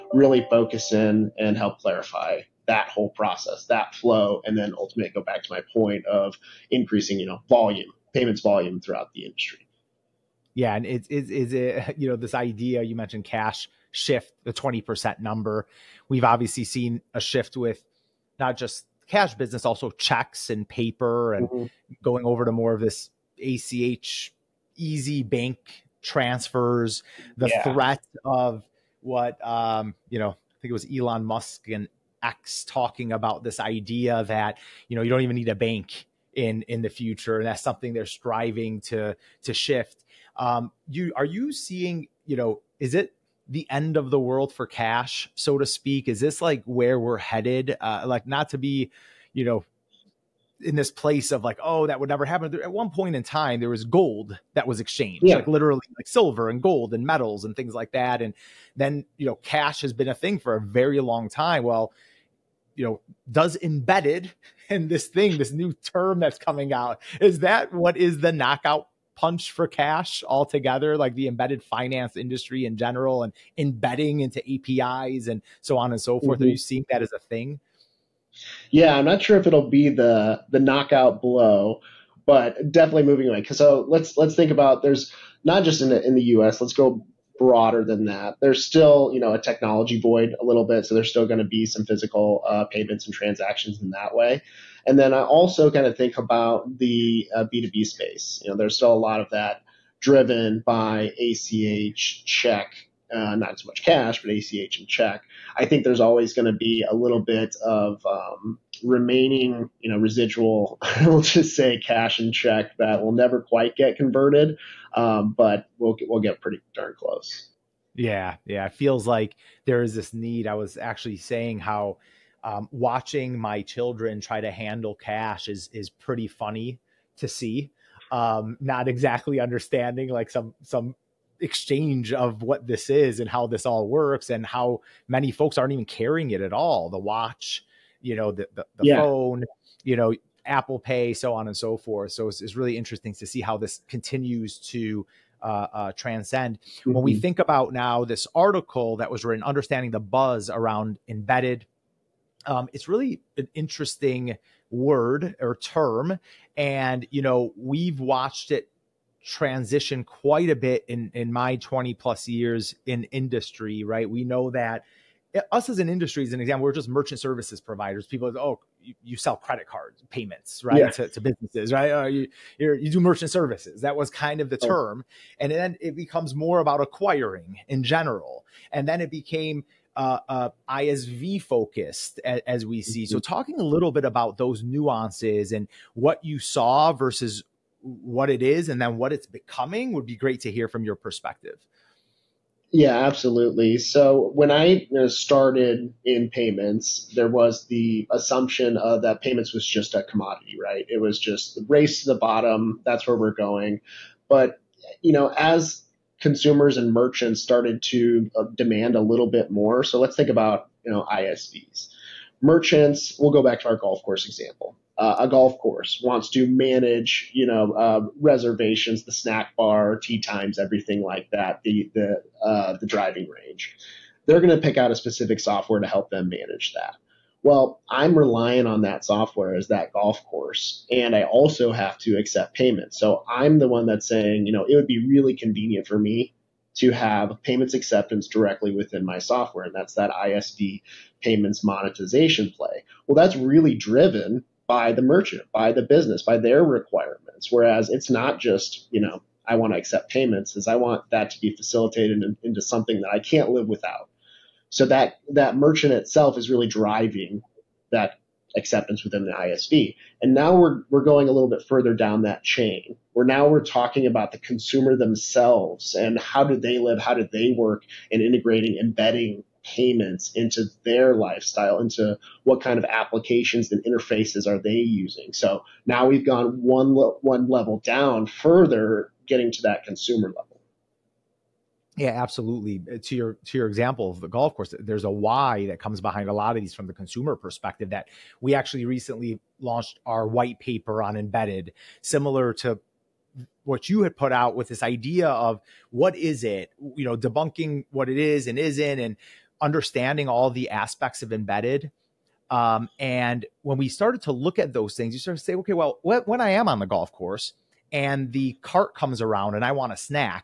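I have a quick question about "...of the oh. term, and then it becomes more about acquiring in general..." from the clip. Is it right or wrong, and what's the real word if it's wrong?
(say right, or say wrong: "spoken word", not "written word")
right.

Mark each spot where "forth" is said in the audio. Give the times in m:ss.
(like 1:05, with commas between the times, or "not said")
1:16, 2:21.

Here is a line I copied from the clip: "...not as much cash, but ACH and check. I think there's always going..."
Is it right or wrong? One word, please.
right.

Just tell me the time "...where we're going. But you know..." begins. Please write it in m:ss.
3:23.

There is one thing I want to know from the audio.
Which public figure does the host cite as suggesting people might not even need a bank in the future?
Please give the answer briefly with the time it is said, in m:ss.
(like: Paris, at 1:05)
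Elon Musk, at 0:30.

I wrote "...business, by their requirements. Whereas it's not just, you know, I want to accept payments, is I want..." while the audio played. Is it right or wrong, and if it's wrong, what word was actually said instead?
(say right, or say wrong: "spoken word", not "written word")
right.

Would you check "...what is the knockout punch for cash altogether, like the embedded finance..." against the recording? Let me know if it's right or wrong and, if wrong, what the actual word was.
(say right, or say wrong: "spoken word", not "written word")
right.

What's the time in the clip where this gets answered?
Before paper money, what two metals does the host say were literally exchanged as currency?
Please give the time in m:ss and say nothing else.
0:56.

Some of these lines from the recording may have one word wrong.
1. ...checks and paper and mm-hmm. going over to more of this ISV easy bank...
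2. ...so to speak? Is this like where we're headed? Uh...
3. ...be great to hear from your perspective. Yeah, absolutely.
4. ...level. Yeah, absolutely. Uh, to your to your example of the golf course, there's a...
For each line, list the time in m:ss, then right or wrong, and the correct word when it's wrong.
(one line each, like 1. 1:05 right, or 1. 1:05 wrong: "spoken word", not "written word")
1. 0:19 wrong: "ACH", not "ISV"
2. 0:45 right
3. 3:10 right
4. 4:40 right.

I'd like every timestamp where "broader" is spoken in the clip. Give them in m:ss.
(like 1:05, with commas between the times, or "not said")
1:27.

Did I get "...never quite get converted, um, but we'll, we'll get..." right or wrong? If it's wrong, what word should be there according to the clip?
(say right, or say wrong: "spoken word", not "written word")
right.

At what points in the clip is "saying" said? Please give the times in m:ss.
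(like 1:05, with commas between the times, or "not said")
2:01, 3:54.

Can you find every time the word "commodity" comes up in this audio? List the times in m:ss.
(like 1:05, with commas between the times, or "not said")
3:20.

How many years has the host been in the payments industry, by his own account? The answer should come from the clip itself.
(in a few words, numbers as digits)
20 plus years.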